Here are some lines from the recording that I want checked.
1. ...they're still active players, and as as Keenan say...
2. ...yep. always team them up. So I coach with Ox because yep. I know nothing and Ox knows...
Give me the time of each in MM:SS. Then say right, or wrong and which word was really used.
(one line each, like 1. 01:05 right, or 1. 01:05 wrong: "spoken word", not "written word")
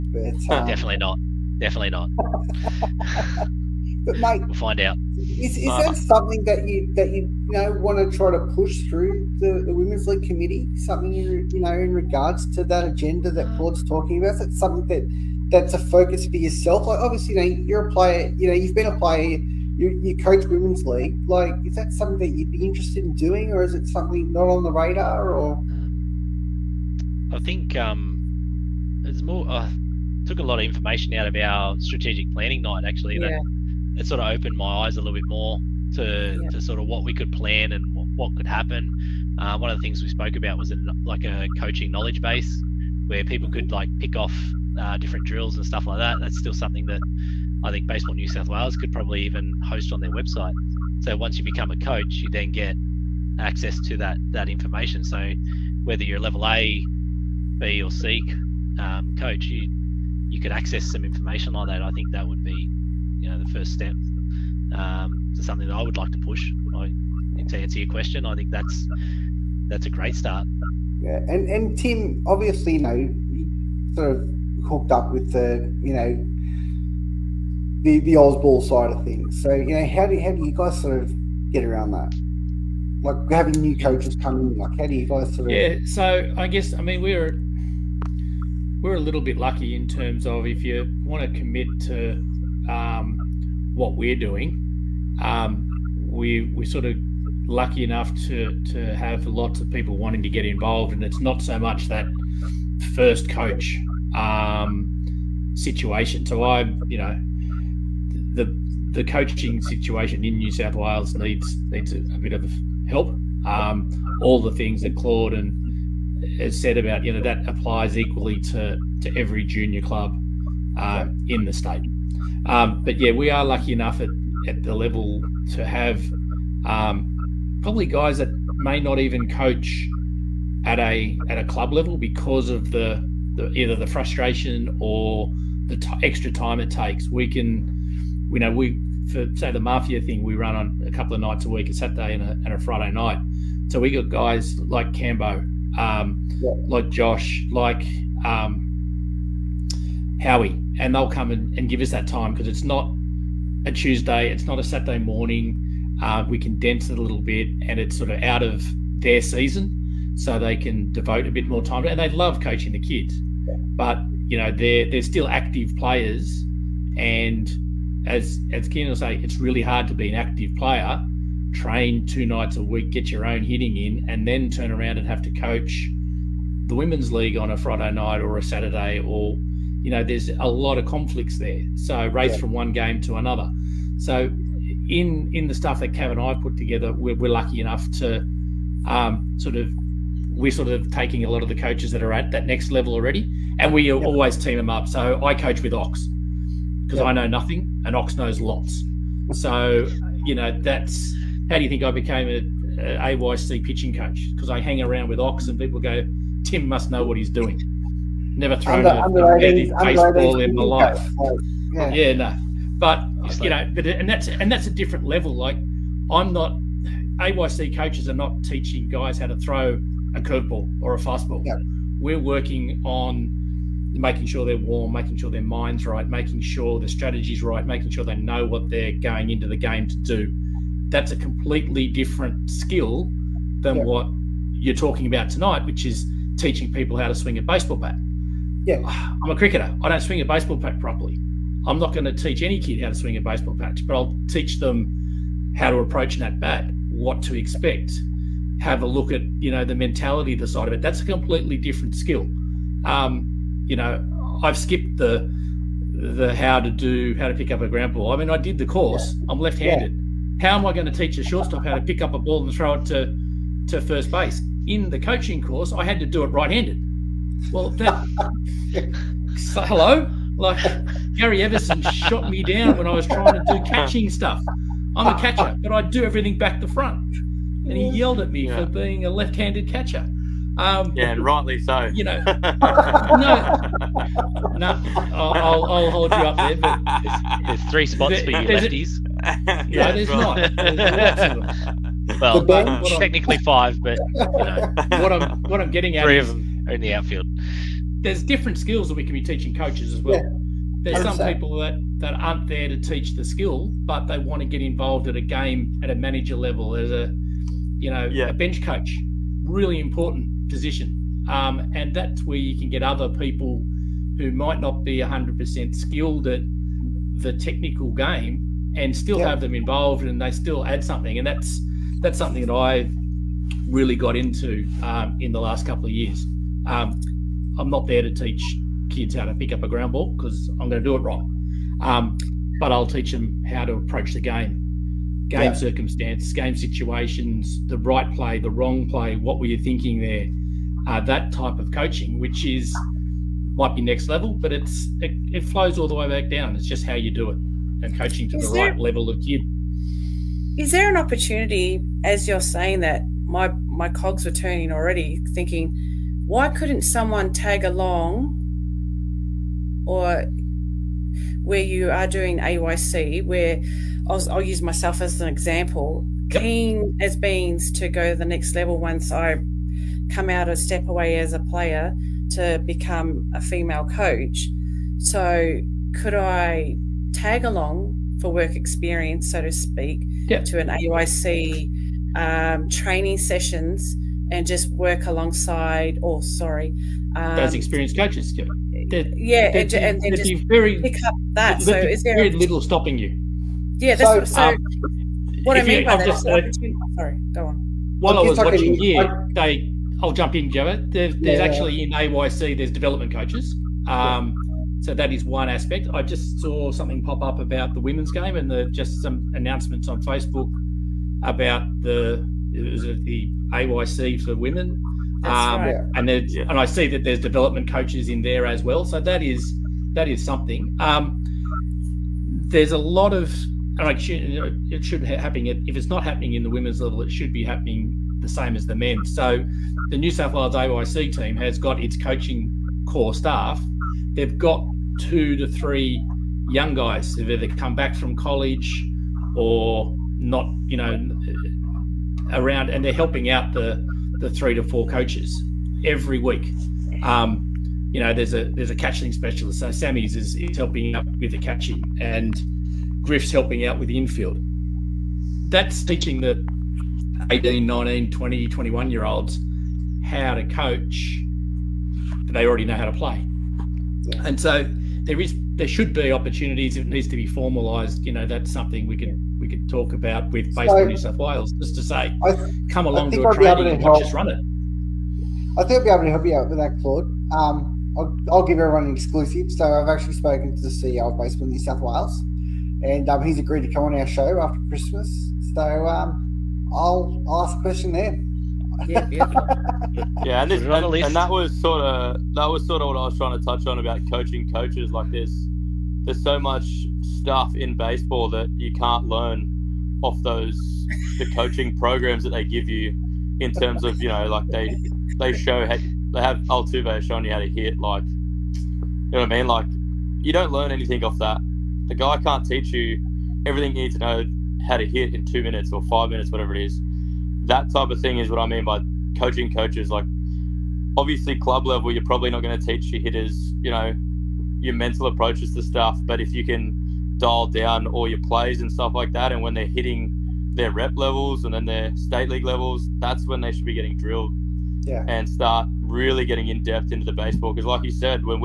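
1. 02:44 right
2. 03:13 right.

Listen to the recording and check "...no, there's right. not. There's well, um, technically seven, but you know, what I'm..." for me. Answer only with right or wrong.
wrong.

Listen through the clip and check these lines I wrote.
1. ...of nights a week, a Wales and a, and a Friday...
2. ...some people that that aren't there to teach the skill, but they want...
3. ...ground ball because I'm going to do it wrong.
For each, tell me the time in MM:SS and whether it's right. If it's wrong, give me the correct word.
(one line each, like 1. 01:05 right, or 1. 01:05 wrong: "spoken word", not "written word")
1. 02:21 wrong: "Saturday", not "Wales"
2. 05:01 right
3. 05:29 right.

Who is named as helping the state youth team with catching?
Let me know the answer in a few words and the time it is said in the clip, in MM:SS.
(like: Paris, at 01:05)
Sammy, at 07:29.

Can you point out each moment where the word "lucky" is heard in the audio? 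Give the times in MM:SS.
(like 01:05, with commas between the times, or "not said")
01:29, 01:37, 02:03, 03:07.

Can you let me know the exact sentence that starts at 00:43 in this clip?
could like pick off uh, different drills and stuff like that.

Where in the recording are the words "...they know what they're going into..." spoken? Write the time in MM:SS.
03:48.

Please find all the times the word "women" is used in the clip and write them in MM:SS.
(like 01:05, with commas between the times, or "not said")
00:09, 00:20, 02:56, 06:47, 06:54, 07:06.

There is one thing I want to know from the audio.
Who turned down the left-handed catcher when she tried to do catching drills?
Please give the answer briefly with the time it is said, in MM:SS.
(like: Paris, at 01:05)
Gary Everson, at 04:31.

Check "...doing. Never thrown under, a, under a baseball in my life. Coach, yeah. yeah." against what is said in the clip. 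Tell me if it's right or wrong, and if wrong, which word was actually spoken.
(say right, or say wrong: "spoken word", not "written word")
right.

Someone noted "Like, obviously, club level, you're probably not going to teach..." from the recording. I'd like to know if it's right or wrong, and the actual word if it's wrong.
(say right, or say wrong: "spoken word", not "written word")
right.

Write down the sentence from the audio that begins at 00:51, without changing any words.
So once you become a coach, you then get access to that that information.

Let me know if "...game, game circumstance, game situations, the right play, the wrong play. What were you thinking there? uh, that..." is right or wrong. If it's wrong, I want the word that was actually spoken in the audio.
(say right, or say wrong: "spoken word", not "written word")
right.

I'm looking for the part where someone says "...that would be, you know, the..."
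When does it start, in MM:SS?
01:02.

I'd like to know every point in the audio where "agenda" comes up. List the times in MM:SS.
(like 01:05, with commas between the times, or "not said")
00:12.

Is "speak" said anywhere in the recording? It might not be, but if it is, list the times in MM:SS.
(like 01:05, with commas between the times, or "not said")
06:19.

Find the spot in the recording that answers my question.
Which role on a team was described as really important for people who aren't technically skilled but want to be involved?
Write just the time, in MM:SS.
05:08.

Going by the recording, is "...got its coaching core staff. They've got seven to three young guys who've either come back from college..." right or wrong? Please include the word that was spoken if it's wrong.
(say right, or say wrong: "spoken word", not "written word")
wrong: "two", not "seven".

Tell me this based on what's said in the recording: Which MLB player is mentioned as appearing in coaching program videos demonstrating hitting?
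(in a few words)
Altuve.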